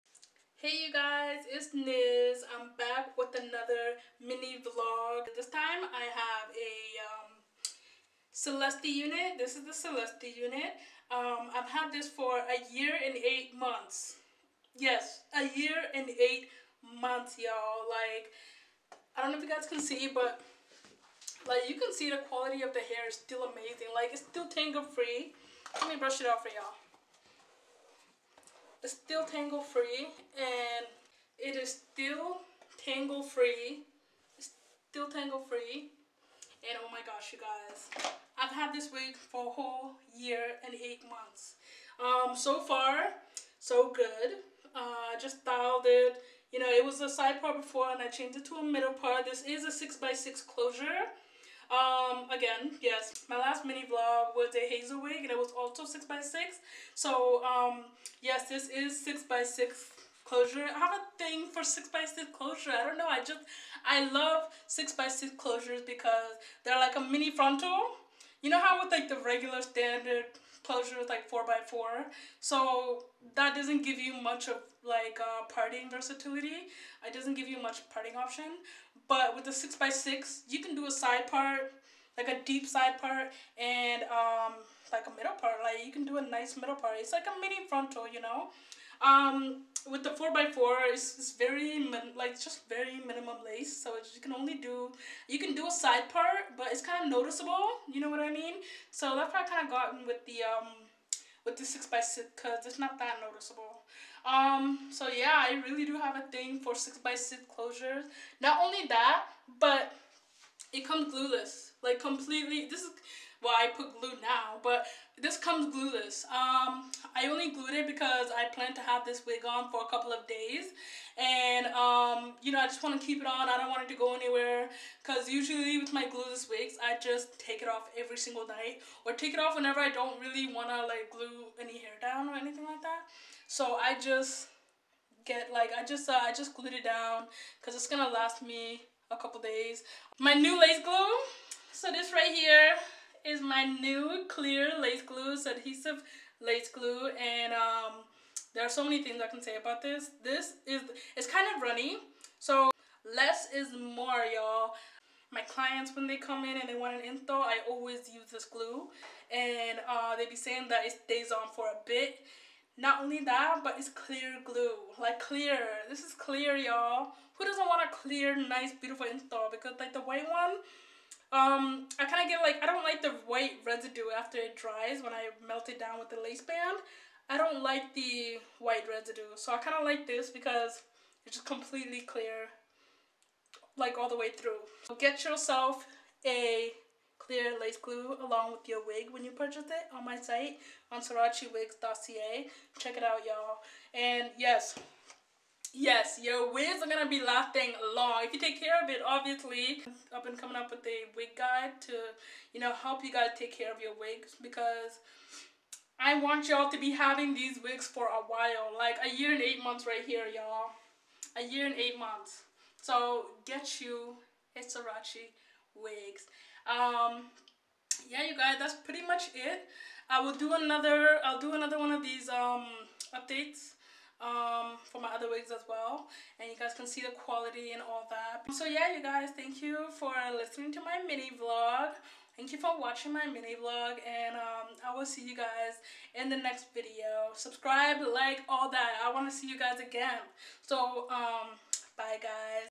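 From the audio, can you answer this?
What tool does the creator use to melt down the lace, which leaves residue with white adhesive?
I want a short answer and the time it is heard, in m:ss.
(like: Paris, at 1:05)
Lace band, at 2:56.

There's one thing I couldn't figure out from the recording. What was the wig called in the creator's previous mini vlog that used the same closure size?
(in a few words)
Hazel.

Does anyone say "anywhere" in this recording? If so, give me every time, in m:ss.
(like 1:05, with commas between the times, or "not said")
2:04.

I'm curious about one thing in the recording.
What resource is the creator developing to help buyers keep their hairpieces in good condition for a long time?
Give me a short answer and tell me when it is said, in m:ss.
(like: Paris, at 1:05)
A wig guide, at 3:21.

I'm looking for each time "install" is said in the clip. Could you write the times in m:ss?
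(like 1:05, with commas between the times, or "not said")
2:37, 2:49.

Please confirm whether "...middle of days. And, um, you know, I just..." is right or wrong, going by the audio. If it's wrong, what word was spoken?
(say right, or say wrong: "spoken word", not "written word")
wrong: "couple", not "middle".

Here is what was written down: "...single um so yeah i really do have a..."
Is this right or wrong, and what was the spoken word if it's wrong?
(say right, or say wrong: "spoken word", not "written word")
wrong: "noticeable", not "single".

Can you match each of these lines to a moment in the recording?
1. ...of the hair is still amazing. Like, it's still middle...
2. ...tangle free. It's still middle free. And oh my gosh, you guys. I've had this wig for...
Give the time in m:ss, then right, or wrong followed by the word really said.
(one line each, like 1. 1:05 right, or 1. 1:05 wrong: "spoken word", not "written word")
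1. 0:22 wrong: "tangle", not "middle"
2. 0:32 wrong: "tangle", not "middle".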